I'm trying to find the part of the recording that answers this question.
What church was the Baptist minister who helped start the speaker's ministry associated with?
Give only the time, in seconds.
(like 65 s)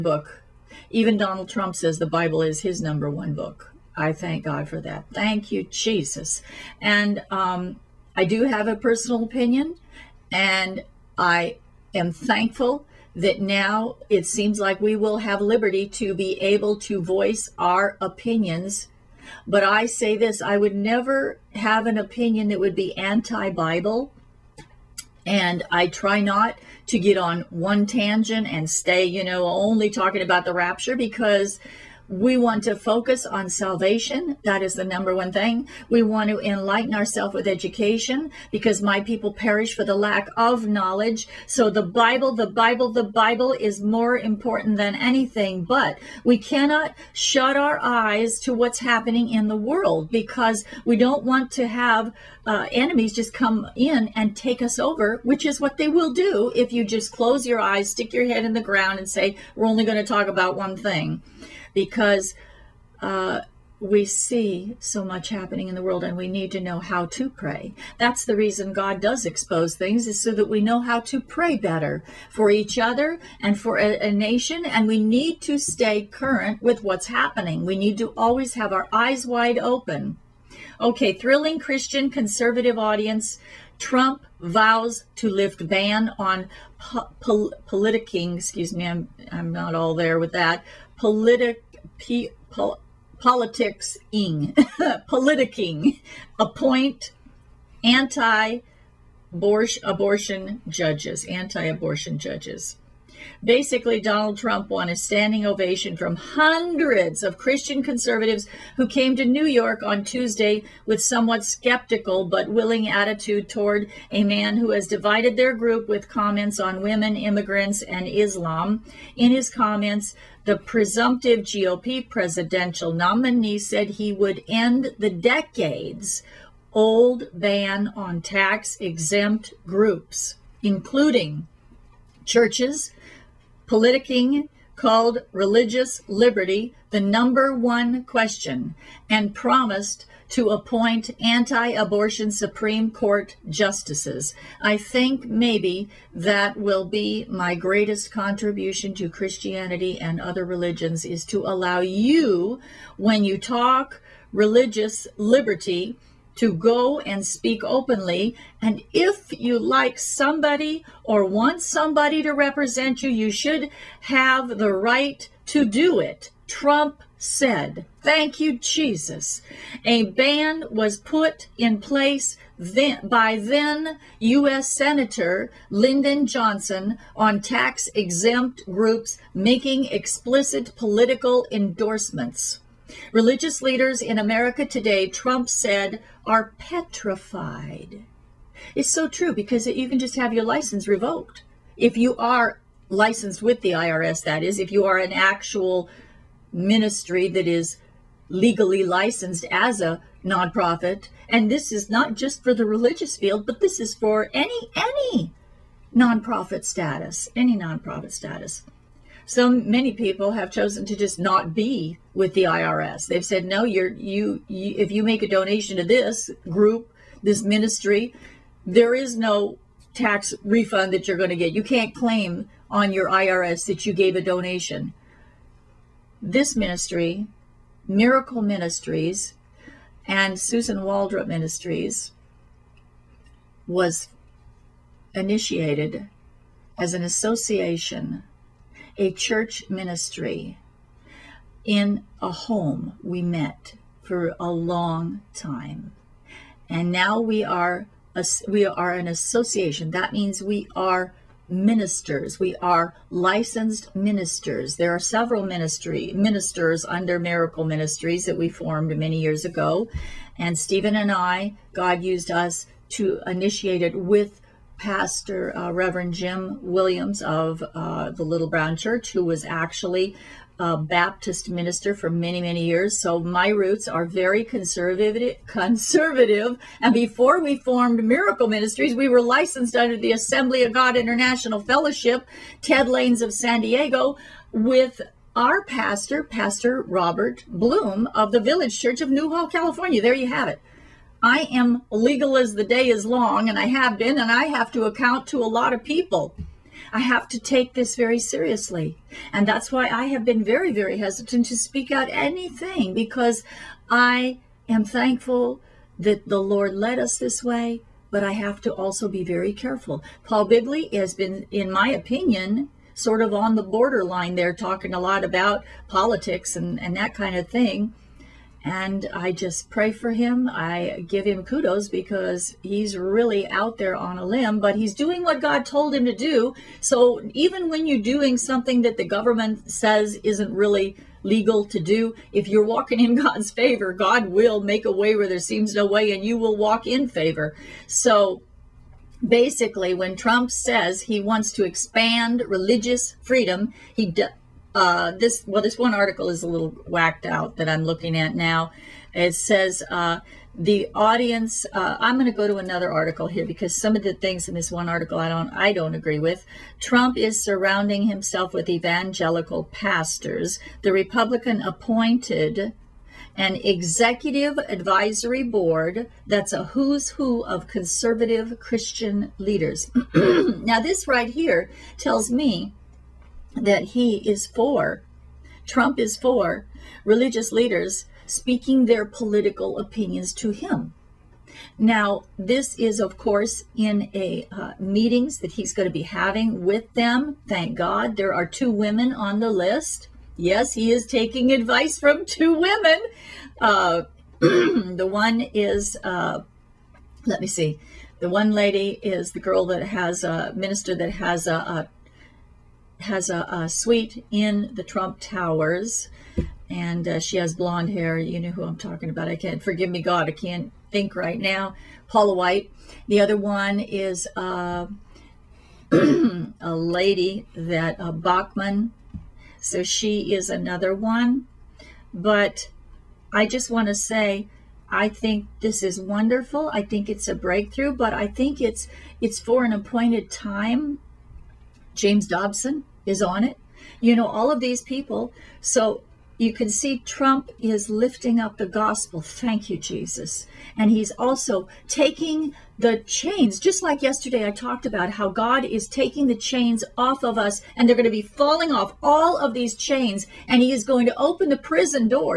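268 s.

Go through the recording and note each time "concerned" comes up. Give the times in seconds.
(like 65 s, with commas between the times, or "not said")
not said.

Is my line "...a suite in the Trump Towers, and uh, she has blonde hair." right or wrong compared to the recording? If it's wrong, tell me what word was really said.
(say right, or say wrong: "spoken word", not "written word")
right.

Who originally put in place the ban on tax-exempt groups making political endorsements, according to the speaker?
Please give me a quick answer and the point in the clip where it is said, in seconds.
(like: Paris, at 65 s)
Lyndon Johnson, at 175 s.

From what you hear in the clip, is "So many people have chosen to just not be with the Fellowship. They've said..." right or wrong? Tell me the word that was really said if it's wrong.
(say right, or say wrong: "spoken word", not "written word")
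wrong: "IRS", not "Fellowship".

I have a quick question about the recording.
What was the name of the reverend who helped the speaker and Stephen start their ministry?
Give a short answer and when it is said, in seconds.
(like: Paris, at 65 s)
Jim Williams, at 266 s.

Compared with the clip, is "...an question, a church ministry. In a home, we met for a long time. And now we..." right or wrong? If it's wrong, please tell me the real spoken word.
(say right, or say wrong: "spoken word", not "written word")
wrong: "association", not "question".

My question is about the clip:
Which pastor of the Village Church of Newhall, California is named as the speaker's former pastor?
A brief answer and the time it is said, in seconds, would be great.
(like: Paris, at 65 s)
Robert Bloom, at 286 s.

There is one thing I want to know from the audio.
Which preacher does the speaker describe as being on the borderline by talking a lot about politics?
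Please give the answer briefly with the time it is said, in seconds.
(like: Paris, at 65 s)
Paul Begley, at 310 s.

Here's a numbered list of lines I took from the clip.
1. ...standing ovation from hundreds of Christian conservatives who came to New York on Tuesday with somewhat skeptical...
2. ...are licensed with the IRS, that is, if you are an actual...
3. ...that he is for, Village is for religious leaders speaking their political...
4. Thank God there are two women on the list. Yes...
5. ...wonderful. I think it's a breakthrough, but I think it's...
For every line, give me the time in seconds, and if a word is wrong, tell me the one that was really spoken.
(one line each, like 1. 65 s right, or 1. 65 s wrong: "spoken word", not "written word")
1. 104 s right
2. 192 s right
3. 373 s wrong: "Trump", not "Village"
4. 387 s right
5. 425 s right.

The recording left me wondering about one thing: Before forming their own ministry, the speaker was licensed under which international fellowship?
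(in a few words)
Assembly of God International Fellowship.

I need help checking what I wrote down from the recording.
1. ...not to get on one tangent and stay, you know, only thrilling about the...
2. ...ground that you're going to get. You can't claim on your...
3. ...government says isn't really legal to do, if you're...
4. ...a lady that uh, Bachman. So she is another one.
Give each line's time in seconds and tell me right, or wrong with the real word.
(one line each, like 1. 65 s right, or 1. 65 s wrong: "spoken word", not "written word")
1. 26 s wrong: "talking", not "thrilling"
2. 220 s wrong: "refund", not "ground"
3. 329 s right
4. 415 s right.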